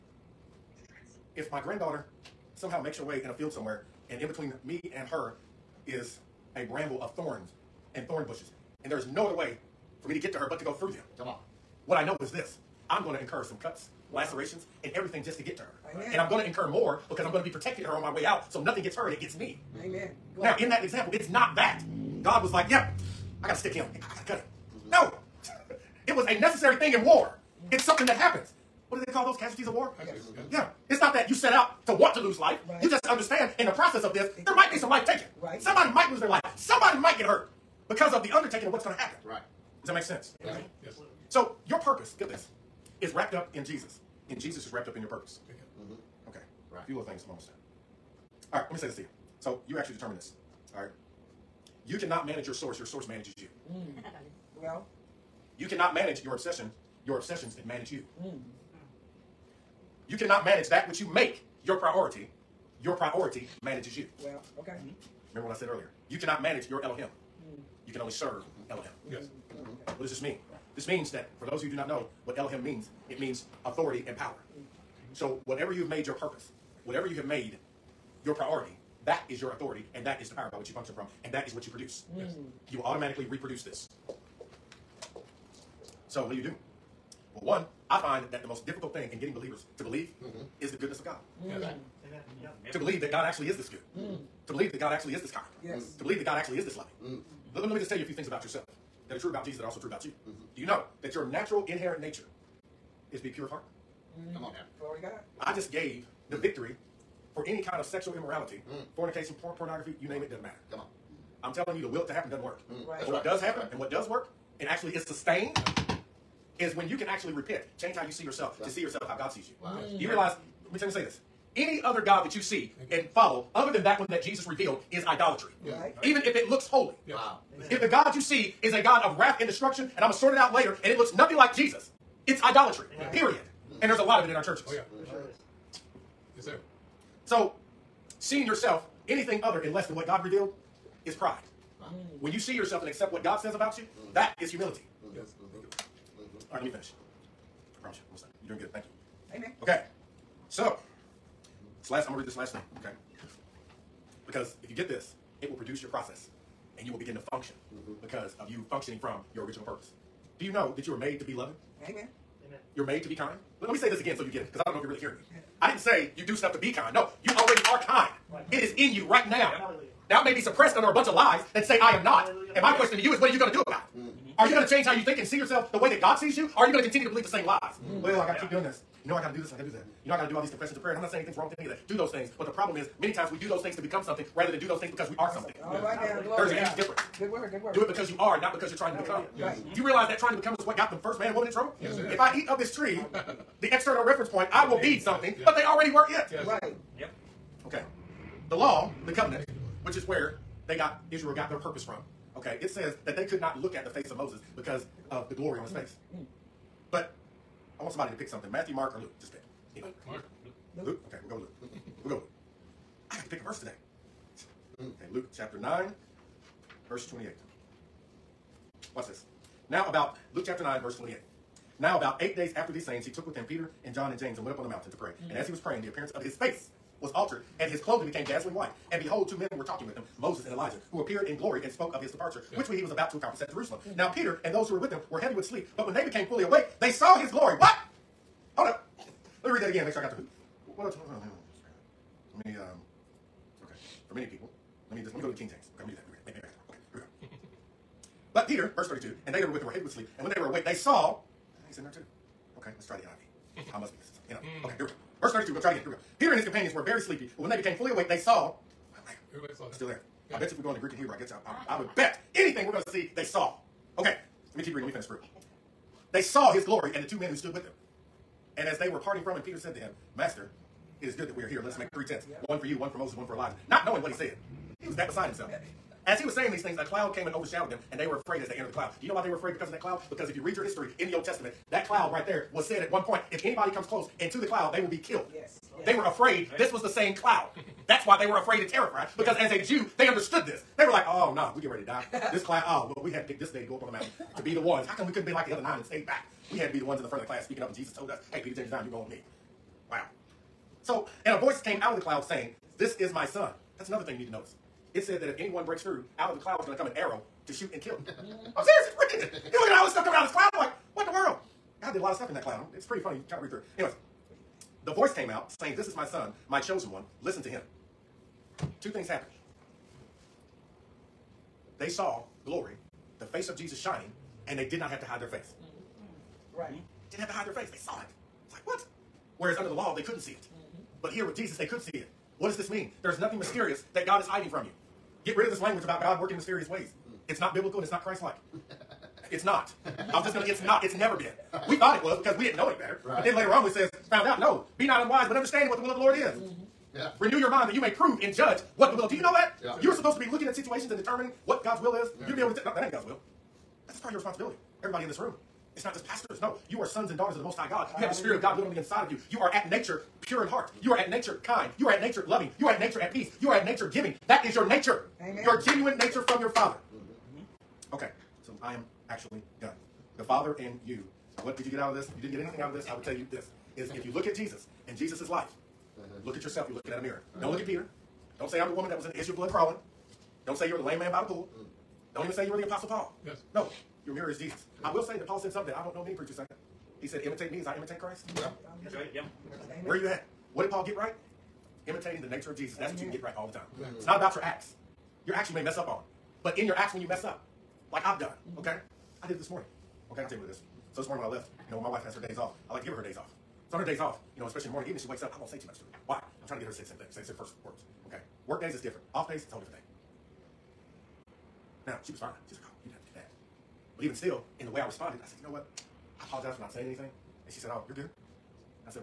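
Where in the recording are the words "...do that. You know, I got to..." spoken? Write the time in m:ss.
2:59.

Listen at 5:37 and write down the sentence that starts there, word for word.
It's not biblical and it's not Christ like.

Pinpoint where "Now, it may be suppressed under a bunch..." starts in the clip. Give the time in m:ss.
2:50.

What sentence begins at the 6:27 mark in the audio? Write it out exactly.
He said, imitate me as I imitate Christ.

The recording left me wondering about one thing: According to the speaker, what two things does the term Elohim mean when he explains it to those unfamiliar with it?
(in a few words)
authority and power.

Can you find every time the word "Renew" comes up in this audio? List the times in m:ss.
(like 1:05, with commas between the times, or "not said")
5:47.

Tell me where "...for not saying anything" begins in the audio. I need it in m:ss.
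6:56.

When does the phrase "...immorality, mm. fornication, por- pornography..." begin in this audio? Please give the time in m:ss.
1:48.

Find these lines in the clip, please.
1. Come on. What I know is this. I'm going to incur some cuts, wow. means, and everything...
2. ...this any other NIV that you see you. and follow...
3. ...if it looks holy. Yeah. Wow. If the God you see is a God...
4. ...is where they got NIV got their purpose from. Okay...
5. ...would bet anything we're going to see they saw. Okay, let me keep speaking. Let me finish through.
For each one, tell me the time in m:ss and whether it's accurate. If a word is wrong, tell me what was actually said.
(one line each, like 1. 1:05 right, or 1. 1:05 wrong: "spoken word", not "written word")
1. 0:11 wrong: "lacerations", not "means"
2. 2:01 wrong: "God", not "NIV"
3. 2:06 right
4. 3:19 wrong: "Israel", not "NIV"
5. 4:21 wrong: "reading", not "speaking".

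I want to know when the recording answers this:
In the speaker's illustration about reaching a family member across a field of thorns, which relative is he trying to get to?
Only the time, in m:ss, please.
0:01.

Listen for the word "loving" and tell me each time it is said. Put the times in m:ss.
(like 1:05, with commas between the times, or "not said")
1:36, 2:41, 6:02.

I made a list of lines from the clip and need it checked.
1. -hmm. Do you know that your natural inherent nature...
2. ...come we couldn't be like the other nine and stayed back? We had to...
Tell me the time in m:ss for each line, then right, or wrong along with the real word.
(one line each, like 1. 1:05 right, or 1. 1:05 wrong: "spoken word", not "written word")
1. 1:40 right
2. 4:54 right.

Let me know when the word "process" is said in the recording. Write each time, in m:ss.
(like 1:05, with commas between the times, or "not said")
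0:33, 2:35.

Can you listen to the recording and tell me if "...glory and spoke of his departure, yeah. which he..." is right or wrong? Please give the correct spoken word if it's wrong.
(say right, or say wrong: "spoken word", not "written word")
right.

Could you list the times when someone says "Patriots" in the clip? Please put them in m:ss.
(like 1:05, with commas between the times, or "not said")
not said.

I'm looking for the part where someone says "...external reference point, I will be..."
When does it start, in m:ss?
3:13.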